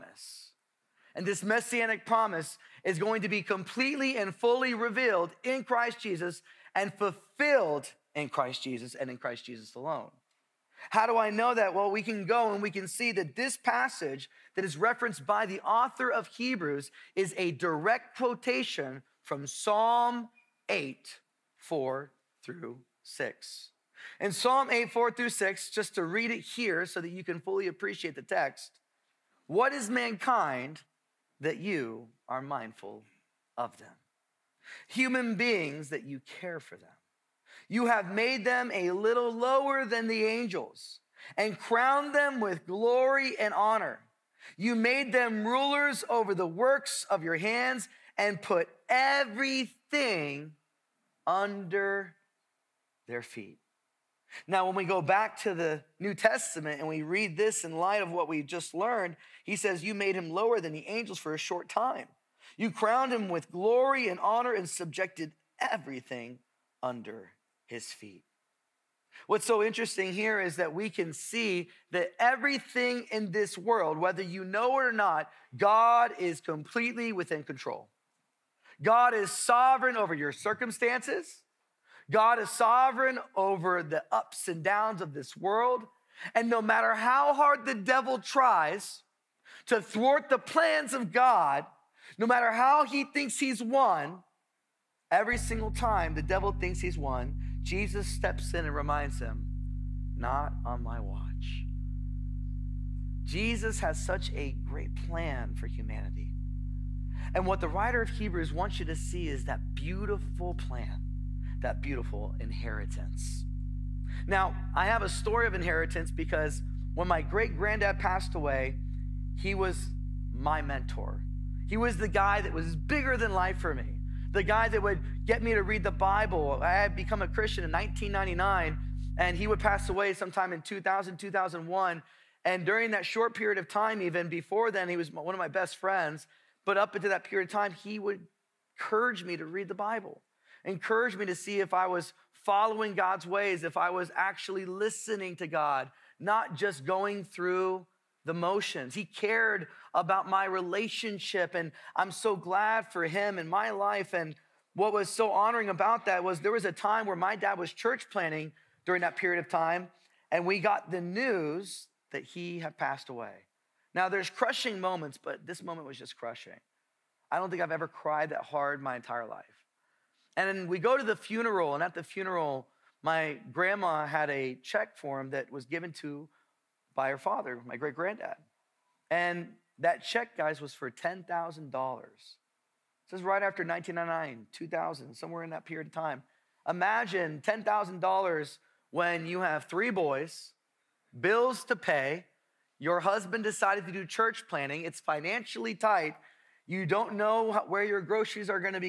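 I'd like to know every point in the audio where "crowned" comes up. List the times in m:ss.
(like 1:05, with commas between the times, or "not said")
0:41, 1:02.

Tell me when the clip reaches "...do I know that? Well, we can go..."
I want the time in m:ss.
0:11.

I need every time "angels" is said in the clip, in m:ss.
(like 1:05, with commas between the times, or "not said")
0:40, 1:00.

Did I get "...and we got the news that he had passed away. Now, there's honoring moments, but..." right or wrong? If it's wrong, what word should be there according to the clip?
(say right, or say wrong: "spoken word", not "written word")
wrong: "crushing", not "honoring".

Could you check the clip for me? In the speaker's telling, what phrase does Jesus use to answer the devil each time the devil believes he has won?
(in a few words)
Not on my watch.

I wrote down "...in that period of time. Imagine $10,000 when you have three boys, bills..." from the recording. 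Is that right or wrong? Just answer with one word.
right.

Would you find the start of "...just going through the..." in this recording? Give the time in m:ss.
2:26.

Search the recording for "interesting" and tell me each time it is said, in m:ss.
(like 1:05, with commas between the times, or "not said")
1:09.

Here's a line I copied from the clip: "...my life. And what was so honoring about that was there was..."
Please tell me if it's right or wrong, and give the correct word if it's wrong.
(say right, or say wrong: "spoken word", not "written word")
right.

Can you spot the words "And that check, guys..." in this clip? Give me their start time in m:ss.
2:59.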